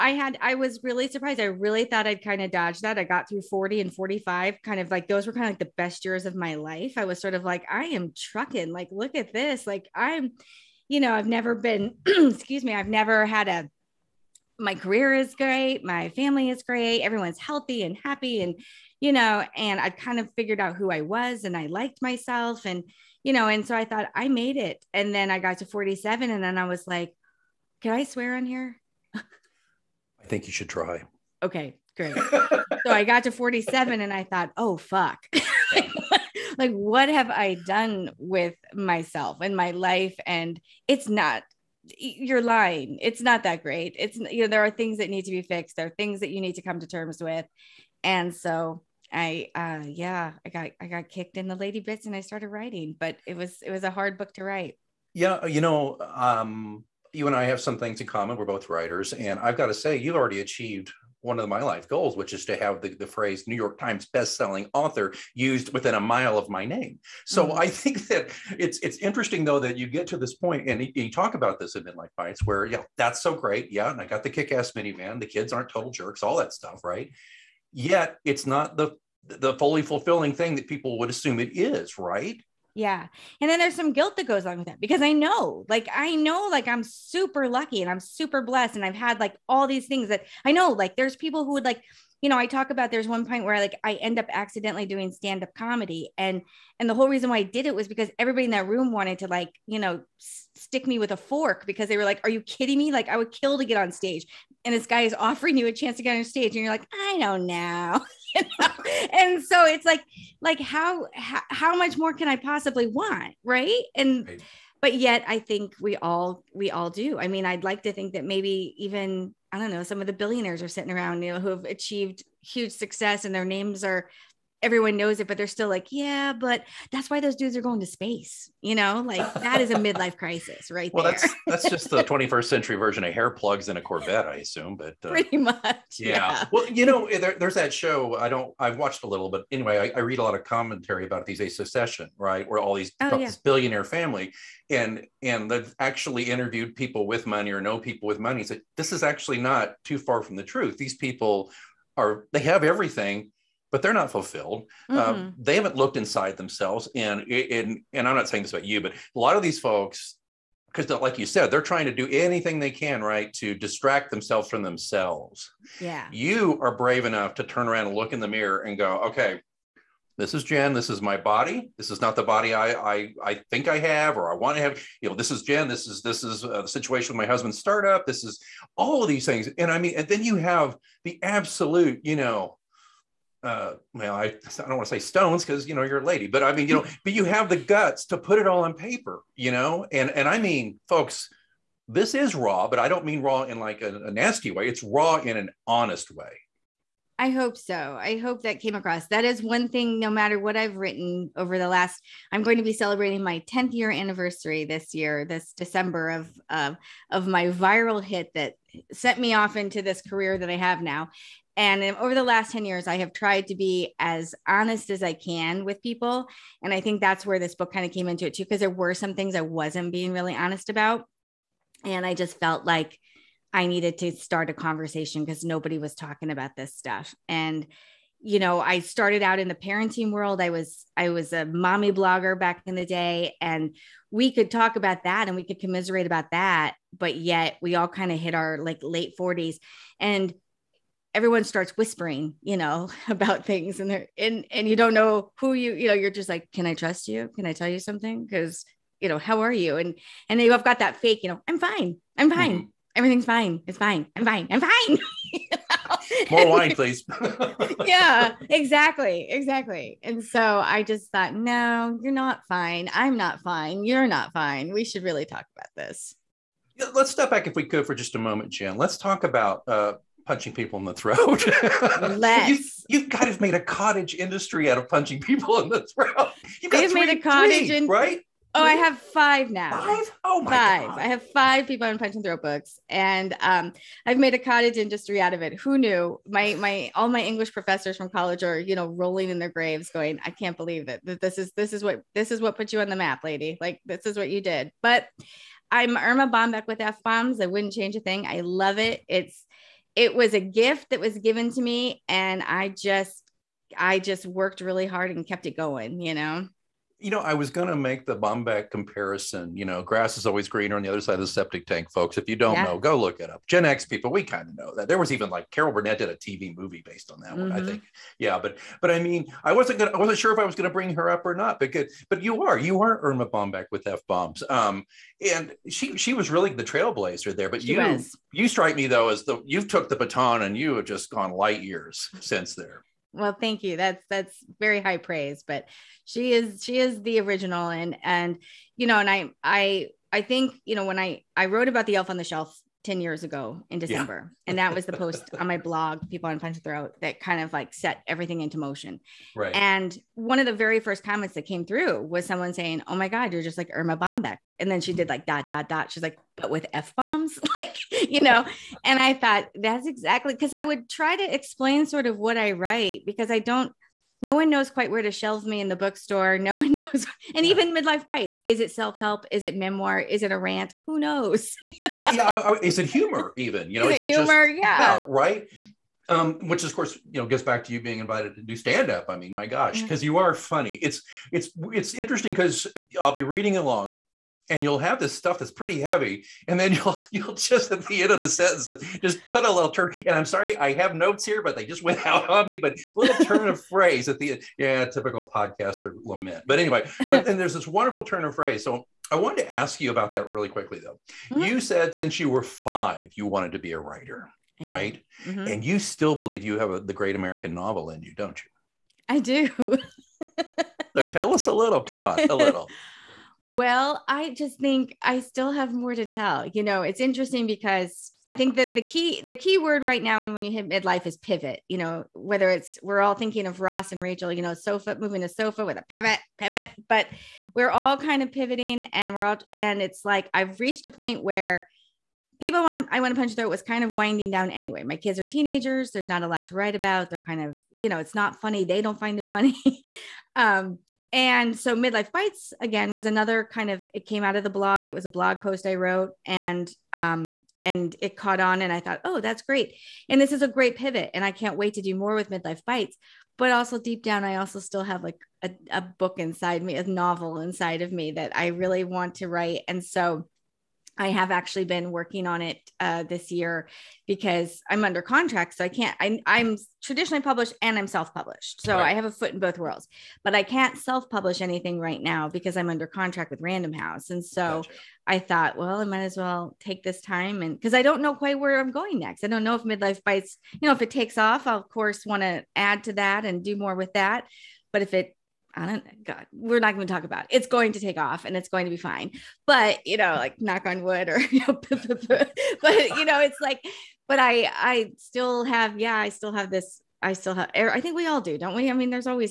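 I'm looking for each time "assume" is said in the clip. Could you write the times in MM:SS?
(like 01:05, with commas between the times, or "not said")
01:21, 02:14.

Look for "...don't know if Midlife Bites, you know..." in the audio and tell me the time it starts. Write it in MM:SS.
07:59.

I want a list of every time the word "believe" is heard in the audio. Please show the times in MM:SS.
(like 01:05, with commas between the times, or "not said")
04:50, 06:46.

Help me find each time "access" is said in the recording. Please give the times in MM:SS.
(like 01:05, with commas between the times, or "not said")
not said.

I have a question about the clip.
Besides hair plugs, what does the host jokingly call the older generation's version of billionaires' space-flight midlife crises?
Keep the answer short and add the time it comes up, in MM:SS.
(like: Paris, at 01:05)
a Corvette, at 02:13.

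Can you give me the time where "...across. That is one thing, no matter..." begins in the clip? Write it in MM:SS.
03:18.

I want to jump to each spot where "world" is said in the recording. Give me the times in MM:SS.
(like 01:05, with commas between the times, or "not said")
03:50, 07:49.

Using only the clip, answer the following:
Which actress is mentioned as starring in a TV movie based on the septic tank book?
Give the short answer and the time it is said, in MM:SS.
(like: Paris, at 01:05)
Carol Burnett, at 05:15.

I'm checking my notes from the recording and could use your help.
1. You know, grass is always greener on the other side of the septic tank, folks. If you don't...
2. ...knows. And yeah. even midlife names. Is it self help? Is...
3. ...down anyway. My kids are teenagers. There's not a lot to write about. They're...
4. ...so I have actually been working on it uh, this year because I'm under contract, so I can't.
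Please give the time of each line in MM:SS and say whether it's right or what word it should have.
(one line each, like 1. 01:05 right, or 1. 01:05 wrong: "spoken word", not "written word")
1. 05:09 right
2. 06:06 wrong: "bites", not "names"
3. 07:14 right
4. 07:39 right.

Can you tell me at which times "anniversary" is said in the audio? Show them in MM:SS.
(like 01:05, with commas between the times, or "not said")
03:23.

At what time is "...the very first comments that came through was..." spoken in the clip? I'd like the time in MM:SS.
05:50.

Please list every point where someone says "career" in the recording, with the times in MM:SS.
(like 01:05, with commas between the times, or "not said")
00:14, 03:30.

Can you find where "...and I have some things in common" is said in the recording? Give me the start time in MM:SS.
00:57.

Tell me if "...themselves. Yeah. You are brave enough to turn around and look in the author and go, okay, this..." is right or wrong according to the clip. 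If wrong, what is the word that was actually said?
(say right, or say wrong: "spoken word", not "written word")
wrong: "mirror", not "author".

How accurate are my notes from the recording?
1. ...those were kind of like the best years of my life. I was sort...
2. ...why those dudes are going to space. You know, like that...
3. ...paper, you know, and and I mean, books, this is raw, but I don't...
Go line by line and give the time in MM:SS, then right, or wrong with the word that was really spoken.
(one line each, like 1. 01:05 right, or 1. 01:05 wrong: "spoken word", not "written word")
1. 00:05 right
2. 02:07 right
3. 03:08 wrong: "folks", not "books".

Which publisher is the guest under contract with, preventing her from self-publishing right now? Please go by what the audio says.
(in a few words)
Random House.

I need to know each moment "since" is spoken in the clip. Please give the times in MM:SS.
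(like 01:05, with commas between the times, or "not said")
05:32, 06:41.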